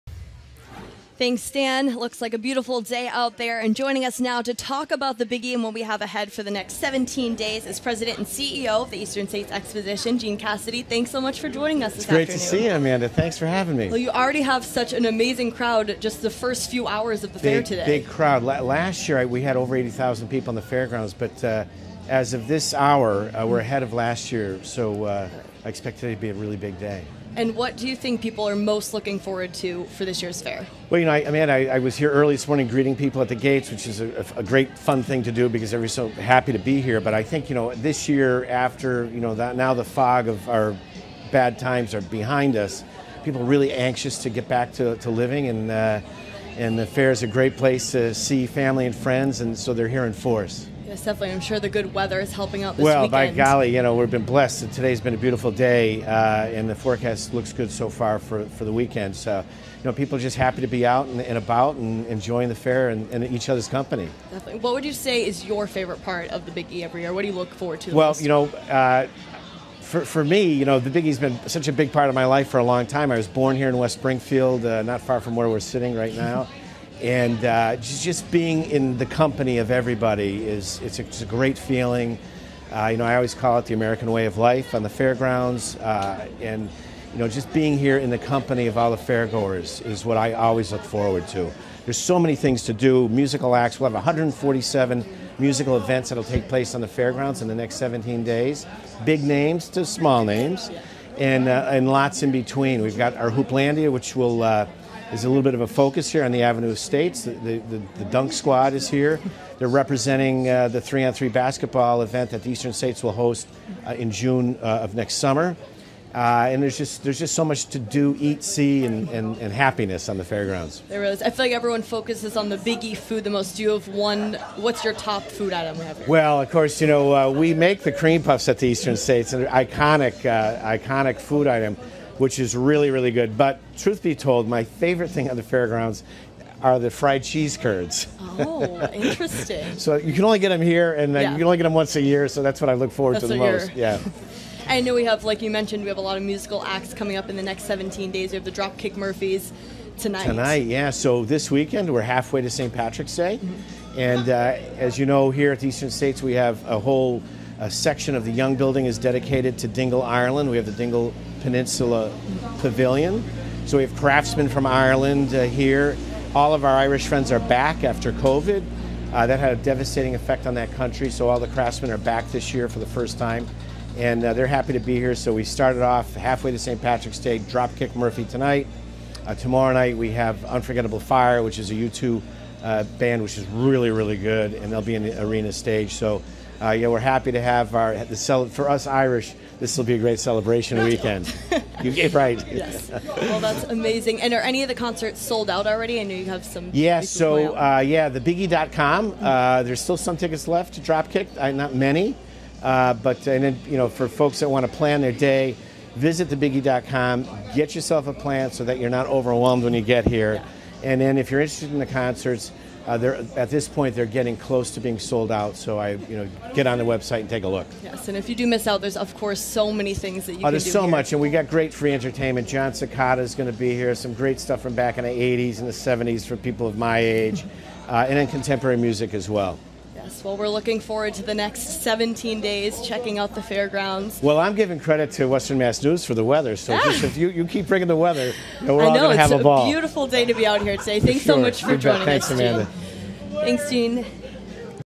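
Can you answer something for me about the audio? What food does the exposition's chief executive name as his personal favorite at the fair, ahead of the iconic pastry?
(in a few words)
Fried cheese curds.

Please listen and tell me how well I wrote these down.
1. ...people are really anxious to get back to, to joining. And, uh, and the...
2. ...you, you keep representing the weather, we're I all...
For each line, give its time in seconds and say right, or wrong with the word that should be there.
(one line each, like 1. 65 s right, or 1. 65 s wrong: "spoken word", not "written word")
1. 43 s wrong: "living", not "joining"
2. 237 s wrong: "bringing", not "representing".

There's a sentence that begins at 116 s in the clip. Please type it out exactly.
Uh, and there's just there's just so much to do, eat, see, and, and, and, happiness on the fairgrounds.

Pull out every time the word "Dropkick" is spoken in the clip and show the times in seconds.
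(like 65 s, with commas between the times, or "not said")
148 s, 177 s, 200 s.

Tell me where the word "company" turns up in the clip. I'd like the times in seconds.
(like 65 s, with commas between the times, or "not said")
63 s, 79 s, 88 s.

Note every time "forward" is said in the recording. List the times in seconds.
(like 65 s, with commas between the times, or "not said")
29 s, 67 s, 90 s, 142 s, 230 s.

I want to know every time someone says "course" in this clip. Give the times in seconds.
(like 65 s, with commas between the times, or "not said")
126 s, 219 s.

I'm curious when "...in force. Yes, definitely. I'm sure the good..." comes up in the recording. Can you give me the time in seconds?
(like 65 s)
50 s.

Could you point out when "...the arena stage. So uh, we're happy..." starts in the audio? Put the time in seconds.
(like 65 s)
185 s.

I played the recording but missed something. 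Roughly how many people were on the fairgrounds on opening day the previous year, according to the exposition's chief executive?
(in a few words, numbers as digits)
80,000.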